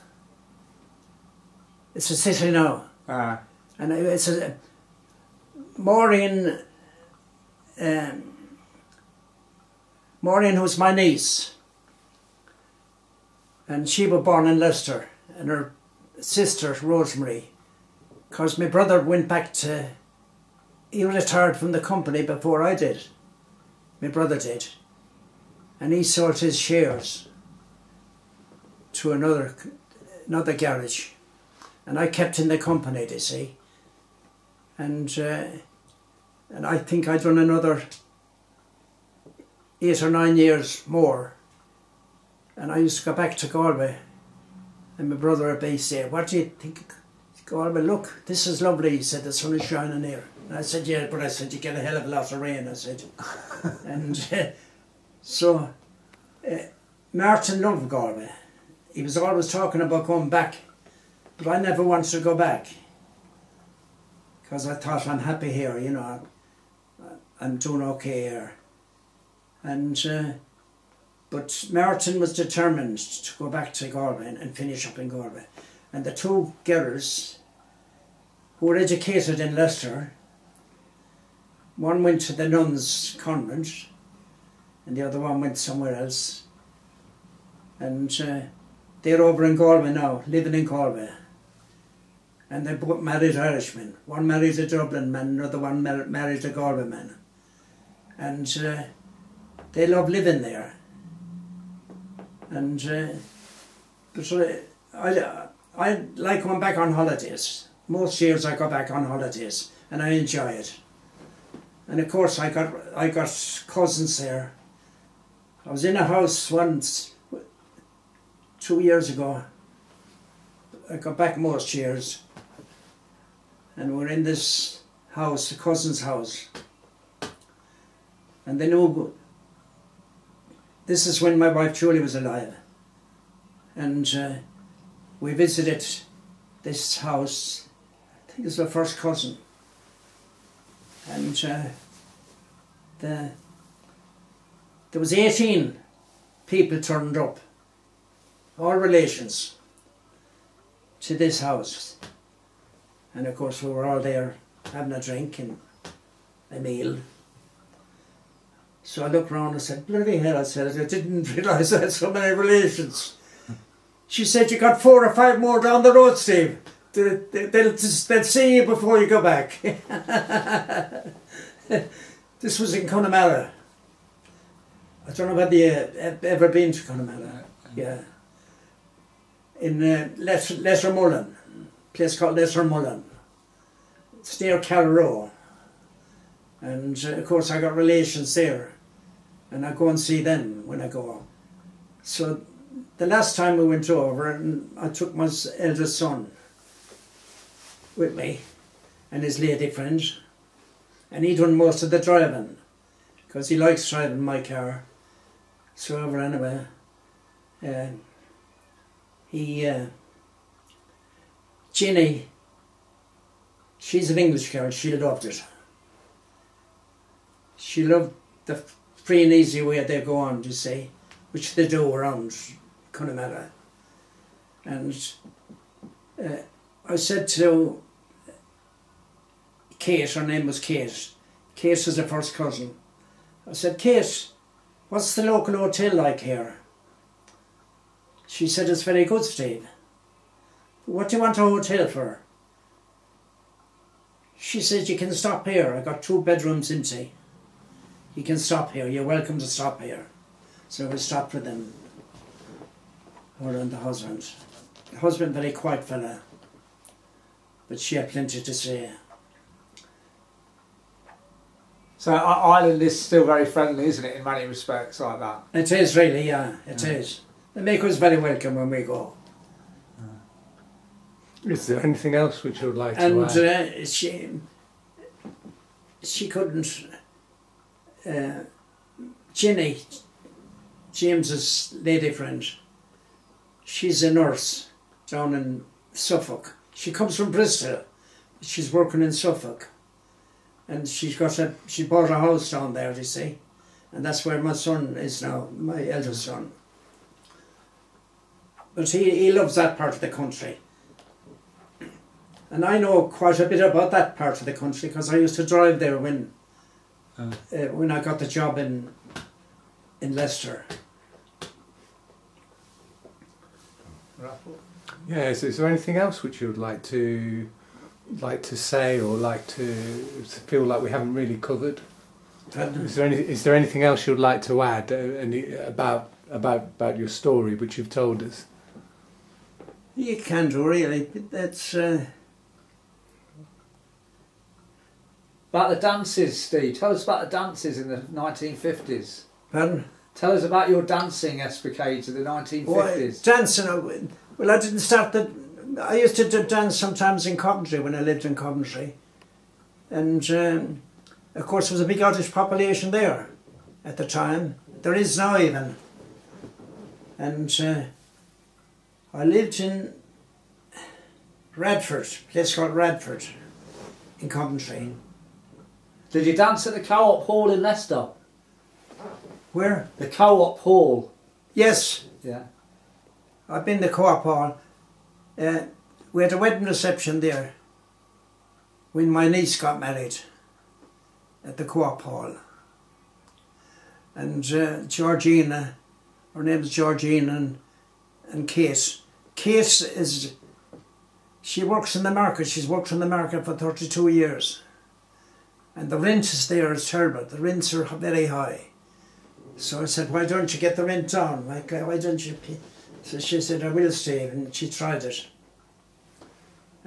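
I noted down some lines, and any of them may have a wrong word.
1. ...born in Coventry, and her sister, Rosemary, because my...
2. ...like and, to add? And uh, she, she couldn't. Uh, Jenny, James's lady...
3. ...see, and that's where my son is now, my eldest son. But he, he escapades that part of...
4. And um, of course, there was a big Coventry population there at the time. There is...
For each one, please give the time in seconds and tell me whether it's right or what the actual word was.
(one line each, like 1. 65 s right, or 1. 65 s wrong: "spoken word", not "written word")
1. 14 s wrong: "Leicester", not "Coventry"
2. 272 s right
3. 293 s wrong: "loves", not "escapades"
4. 349 s wrong: "Irish", not "Coventry".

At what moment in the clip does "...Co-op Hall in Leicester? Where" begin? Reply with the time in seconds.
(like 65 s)
366 s.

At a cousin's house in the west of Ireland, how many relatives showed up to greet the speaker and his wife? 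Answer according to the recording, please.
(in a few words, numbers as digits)
18.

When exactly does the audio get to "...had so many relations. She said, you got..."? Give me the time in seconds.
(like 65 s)
161 s.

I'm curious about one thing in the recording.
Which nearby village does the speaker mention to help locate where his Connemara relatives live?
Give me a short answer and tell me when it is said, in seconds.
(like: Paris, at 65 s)
Carraroe, at 184 s.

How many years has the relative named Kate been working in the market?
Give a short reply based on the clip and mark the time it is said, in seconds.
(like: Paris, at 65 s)
32, at 393 s.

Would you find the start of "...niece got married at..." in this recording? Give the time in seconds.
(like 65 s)
379 s.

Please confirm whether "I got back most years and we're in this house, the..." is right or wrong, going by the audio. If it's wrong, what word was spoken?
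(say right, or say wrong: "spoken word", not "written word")
right.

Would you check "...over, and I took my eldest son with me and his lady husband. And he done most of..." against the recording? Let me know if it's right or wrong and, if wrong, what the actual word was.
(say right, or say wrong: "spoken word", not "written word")
wrong: "friend", not "husband".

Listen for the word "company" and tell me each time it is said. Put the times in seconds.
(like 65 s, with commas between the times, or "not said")
21 s, 32 s.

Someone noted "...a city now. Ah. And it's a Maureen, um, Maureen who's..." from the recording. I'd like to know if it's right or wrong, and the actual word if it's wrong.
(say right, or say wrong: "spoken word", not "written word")
right.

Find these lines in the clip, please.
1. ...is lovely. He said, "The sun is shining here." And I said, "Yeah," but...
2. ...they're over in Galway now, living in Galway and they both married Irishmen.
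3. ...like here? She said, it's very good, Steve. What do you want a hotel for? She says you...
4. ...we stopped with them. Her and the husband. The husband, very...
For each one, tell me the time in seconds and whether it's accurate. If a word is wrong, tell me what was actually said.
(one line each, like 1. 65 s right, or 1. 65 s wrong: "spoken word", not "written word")
1. 48 s right
2. 89 s right
3. 235 s right
4. 250 s right.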